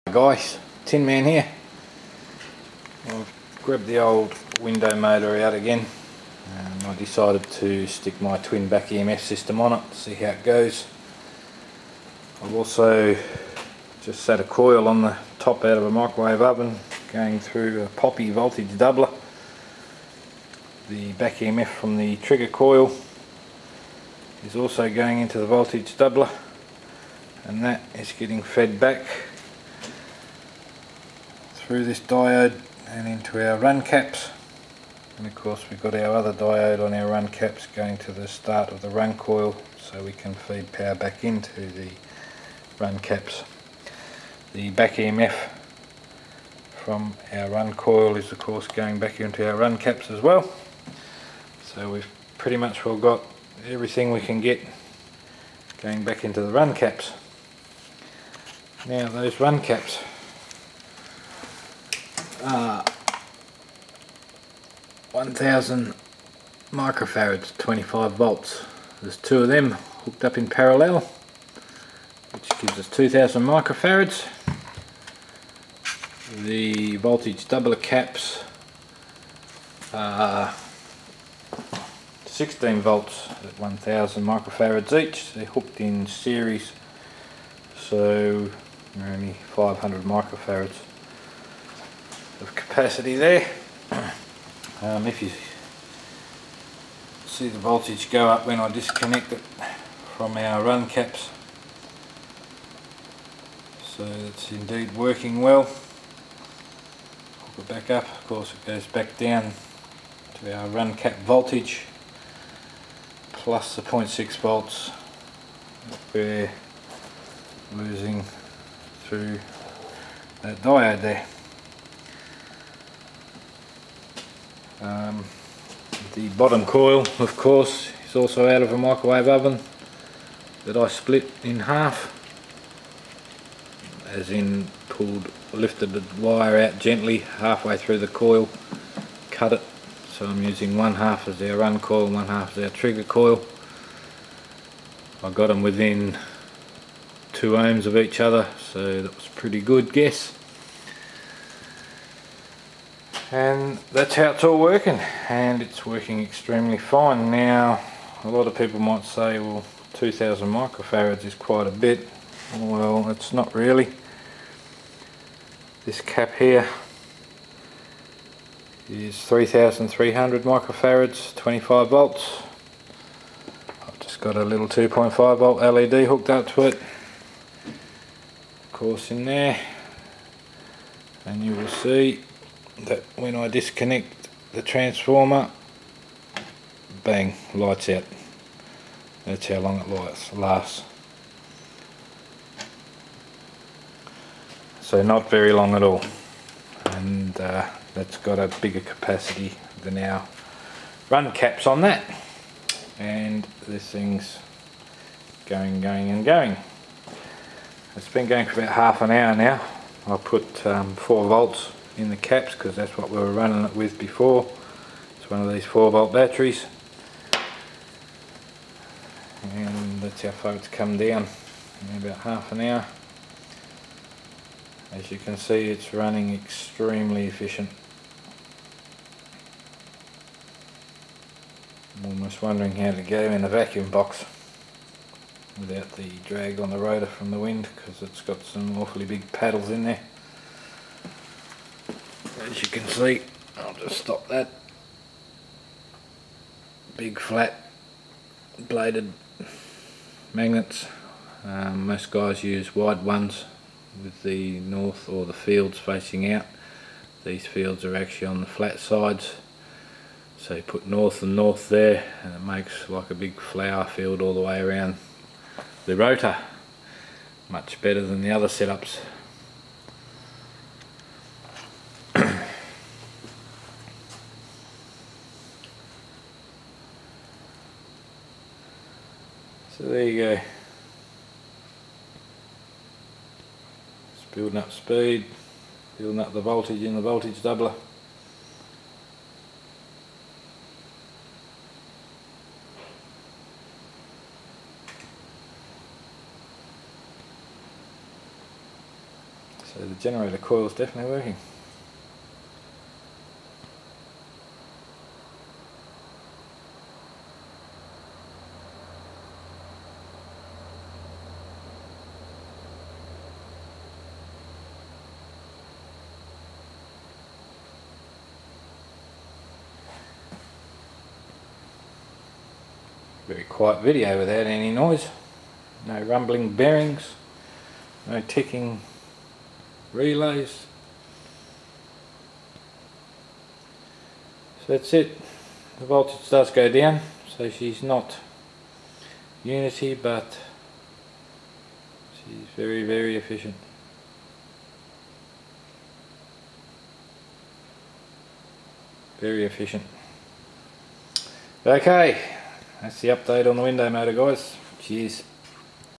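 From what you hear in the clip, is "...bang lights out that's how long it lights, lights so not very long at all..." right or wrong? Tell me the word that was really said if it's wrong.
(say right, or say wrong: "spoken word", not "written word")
wrong: "lasts", not "lights".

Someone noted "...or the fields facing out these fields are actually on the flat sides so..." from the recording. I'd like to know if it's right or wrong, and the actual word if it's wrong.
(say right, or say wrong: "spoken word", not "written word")
right.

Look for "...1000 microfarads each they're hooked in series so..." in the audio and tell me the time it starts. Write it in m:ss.
1:23.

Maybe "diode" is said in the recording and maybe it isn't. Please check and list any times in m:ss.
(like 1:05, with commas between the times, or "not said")
0:31, 0:36, 2:00.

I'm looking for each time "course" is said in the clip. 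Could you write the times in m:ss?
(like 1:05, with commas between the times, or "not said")
0:35, 0:48, 1:48, 2:07, 2:58.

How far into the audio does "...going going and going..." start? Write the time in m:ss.
3:25.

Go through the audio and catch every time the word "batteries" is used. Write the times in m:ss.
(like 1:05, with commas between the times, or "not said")
3:36.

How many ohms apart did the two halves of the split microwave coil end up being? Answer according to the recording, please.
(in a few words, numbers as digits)
2 ohms.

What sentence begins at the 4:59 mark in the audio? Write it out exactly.
So the generator coil is definitely working.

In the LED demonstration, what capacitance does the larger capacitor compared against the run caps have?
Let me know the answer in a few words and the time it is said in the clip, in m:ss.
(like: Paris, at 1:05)
3300 microfarads, at 2:49.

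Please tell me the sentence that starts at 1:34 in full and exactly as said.
Um, if you see the voltage go up when I disconnect it from our run caps, so it's indeed working well.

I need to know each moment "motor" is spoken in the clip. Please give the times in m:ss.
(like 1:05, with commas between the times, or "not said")
0:04, 5:53.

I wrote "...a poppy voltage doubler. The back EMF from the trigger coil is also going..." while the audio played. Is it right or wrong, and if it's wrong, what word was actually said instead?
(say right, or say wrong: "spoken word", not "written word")
right.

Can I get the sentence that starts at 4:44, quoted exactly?
It's building up speed, building up the voltage in the voltage doubler.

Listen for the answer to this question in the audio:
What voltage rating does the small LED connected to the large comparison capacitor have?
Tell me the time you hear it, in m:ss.
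2:54.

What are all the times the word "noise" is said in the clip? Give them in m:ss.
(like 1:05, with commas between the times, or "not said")
5:24.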